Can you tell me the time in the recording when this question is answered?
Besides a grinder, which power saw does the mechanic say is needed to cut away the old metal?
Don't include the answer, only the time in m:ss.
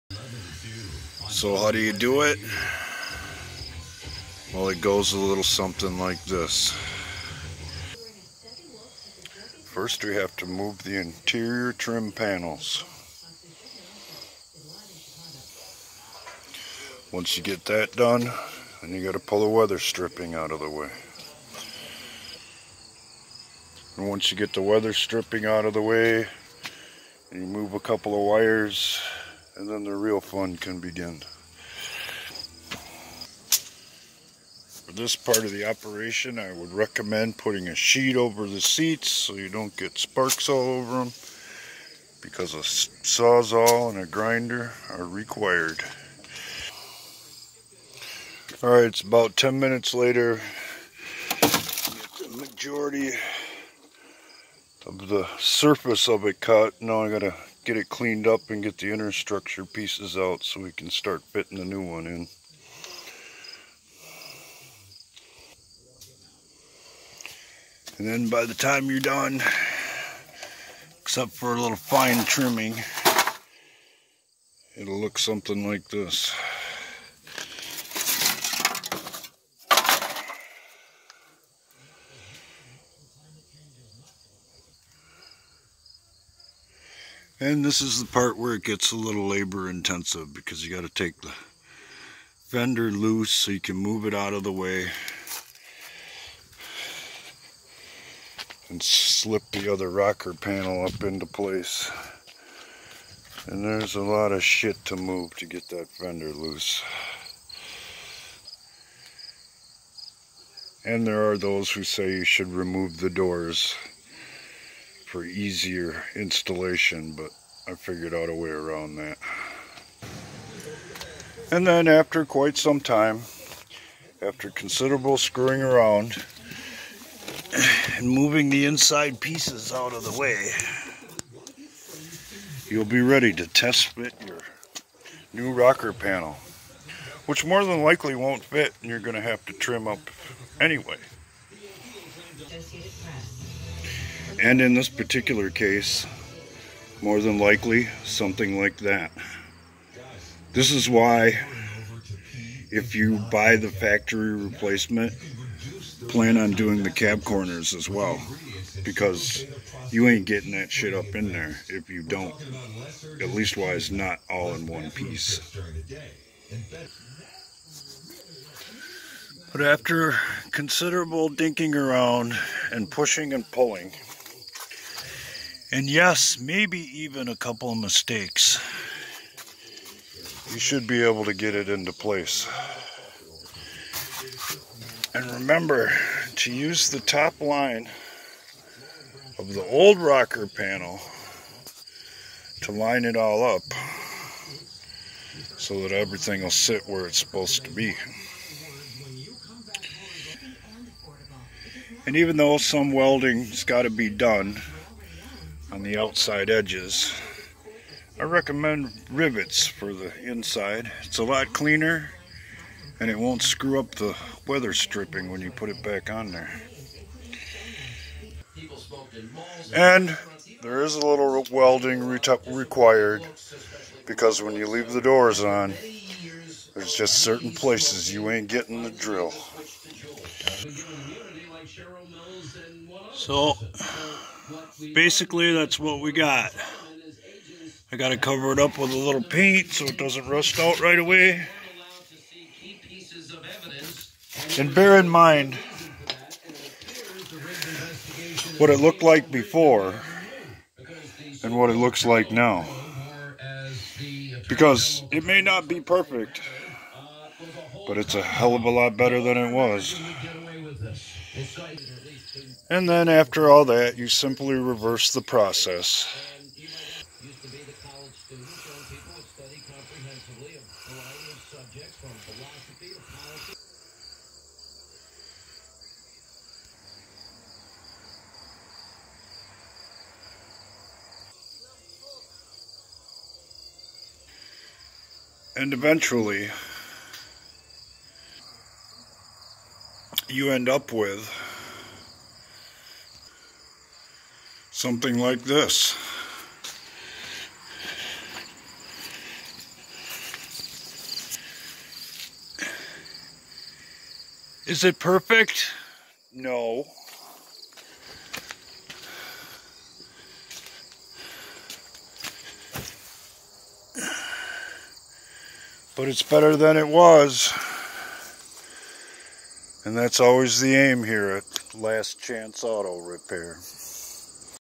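0:42.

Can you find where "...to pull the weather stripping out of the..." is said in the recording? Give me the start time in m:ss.
0:19.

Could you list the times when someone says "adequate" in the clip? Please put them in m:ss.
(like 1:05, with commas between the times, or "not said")
not said.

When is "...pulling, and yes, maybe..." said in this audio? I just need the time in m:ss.
2:53.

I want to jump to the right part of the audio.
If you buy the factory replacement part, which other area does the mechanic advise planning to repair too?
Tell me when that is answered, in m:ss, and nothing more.
2:36.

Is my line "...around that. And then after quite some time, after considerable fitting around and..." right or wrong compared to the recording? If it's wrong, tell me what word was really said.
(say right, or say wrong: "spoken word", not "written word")
wrong: "screwing", not "fitting".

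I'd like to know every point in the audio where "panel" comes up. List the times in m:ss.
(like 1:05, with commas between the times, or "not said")
0:12, 1:40, 2:15, 3:10.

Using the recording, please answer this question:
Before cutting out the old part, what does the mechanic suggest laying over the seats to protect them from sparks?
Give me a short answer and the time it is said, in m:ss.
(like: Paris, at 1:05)
a sheet, at 0:37.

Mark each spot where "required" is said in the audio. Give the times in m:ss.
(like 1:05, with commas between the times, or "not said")
0:45, 3:42.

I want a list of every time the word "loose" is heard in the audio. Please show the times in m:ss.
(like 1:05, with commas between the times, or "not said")
1:32, 1:46.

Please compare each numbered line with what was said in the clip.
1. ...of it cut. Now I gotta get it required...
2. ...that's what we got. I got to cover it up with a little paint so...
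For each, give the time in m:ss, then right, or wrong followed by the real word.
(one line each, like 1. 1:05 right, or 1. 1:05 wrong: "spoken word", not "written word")
1. 0:56 wrong: "cleaned", not "required"
2. 3:55 right.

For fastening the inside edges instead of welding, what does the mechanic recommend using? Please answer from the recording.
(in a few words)
rivets.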